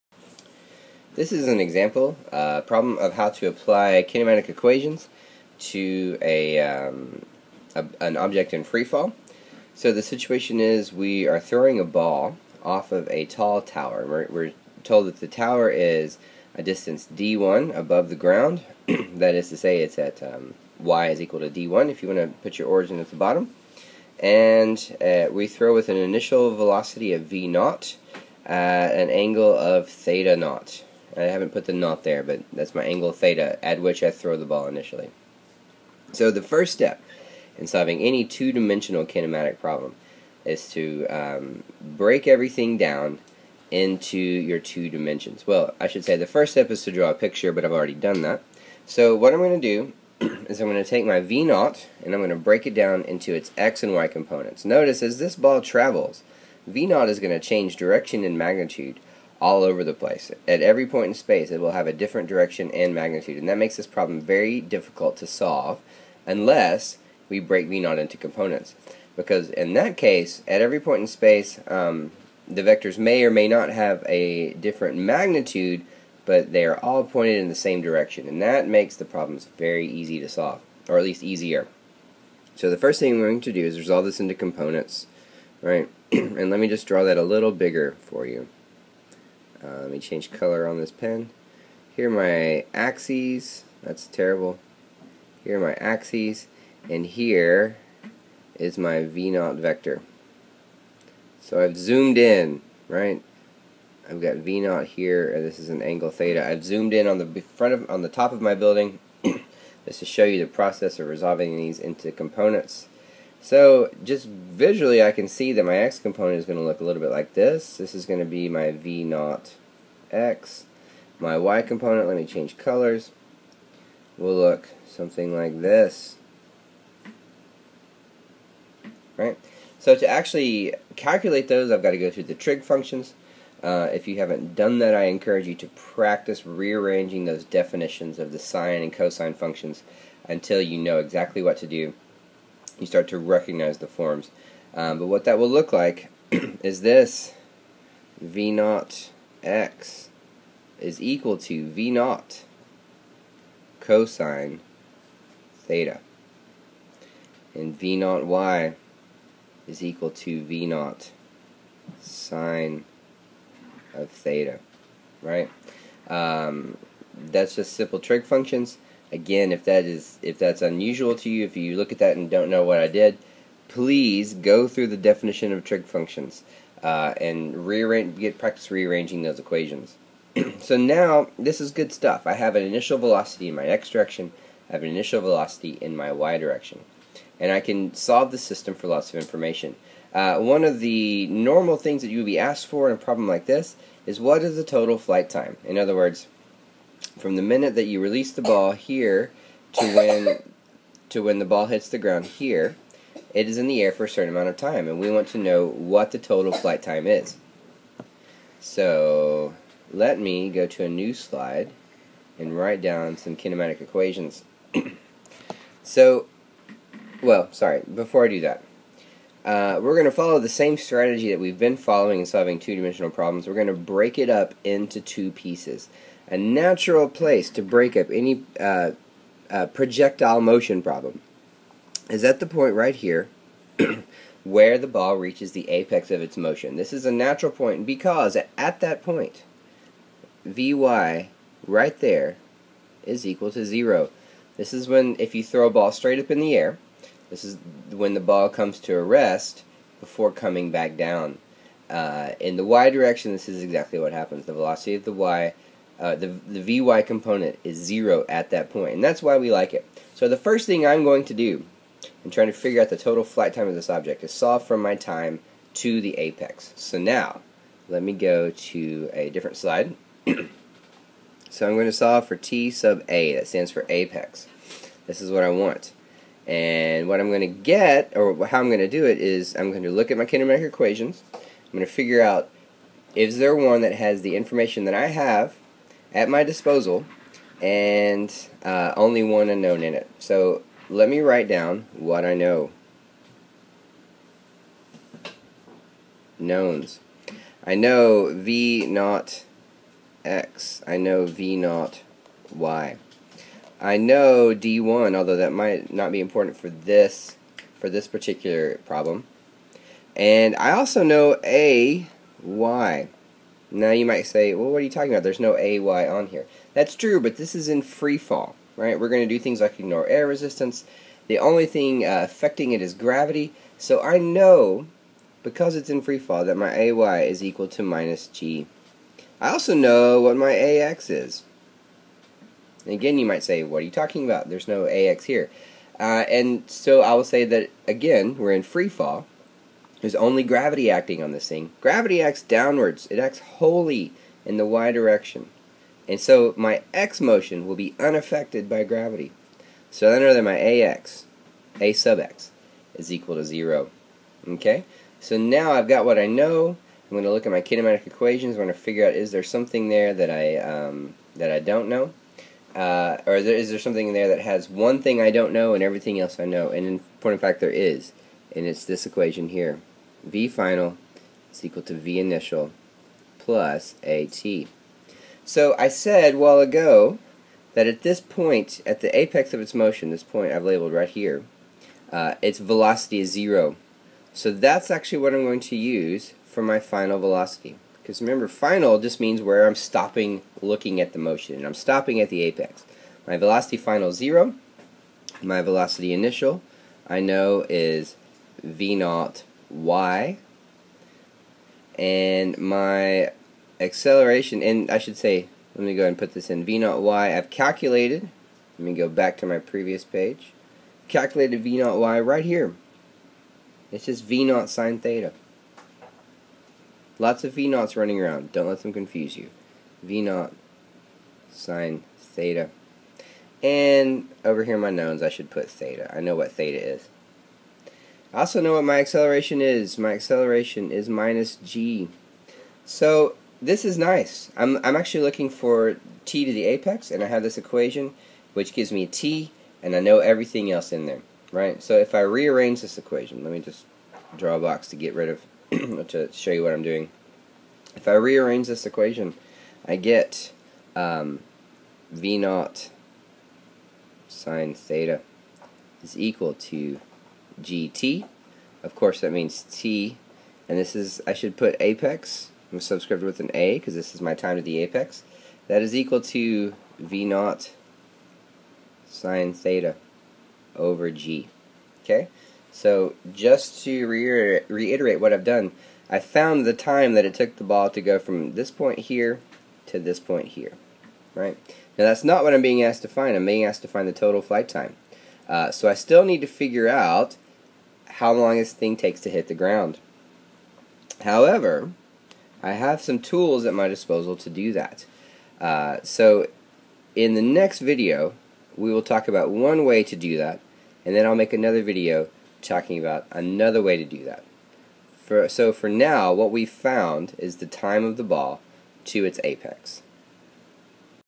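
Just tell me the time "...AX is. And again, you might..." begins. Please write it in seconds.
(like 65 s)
330 s.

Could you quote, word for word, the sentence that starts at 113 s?
So just visually I can see that my x component is going to look a little bit like this.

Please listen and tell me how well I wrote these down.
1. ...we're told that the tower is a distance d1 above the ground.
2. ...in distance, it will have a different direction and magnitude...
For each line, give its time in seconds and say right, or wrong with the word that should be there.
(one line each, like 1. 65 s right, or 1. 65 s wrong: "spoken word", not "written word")
1. 14 s right
2. 61 s wrong: "space", not "distance".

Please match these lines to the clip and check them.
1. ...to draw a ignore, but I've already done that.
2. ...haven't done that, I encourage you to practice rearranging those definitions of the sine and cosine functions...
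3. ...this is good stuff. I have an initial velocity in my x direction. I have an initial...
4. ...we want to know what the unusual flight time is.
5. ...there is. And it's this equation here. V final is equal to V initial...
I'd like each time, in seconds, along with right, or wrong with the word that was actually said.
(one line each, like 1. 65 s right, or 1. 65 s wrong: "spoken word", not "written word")
1. 46 s wrong: "picture", not "ignore"
2. 134 s right
3. 181 s right
4. 204 s wrong: "total", not "unusual"
5. 367 s right.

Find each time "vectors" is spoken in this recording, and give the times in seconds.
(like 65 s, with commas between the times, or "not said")
72 s, 99 s.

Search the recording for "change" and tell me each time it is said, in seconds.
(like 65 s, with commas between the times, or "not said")
57 s, 89 s, 122 s.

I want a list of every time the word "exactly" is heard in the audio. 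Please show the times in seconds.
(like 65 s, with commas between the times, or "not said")
140 s, 253 s.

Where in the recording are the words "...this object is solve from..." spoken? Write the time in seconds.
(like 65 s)
263 s.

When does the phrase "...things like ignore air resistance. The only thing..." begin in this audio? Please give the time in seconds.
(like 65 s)
319 s.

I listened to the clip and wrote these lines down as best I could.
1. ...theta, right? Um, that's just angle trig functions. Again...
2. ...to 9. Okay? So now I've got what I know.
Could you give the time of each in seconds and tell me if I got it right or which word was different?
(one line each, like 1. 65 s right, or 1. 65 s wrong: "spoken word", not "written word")
1. 164 s wrong: "simple", not "angle"
2. 353 s wrong: "0", not "9".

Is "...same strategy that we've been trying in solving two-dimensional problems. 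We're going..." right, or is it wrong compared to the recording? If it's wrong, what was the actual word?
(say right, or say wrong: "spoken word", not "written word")
wrong: "following", not "trying".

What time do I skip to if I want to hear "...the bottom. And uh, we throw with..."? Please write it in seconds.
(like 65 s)
23 s.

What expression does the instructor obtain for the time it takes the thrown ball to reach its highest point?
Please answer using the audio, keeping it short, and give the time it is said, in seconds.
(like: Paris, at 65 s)
V naught sine theta over g, at 466 s.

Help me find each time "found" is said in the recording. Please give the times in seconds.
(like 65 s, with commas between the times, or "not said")
476 s, 506 s.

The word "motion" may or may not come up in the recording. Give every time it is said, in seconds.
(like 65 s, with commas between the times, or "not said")
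230 s, 236 s, 347 s, 379 s, 391 s.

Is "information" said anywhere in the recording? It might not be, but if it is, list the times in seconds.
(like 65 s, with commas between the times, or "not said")
189 s, 284 s.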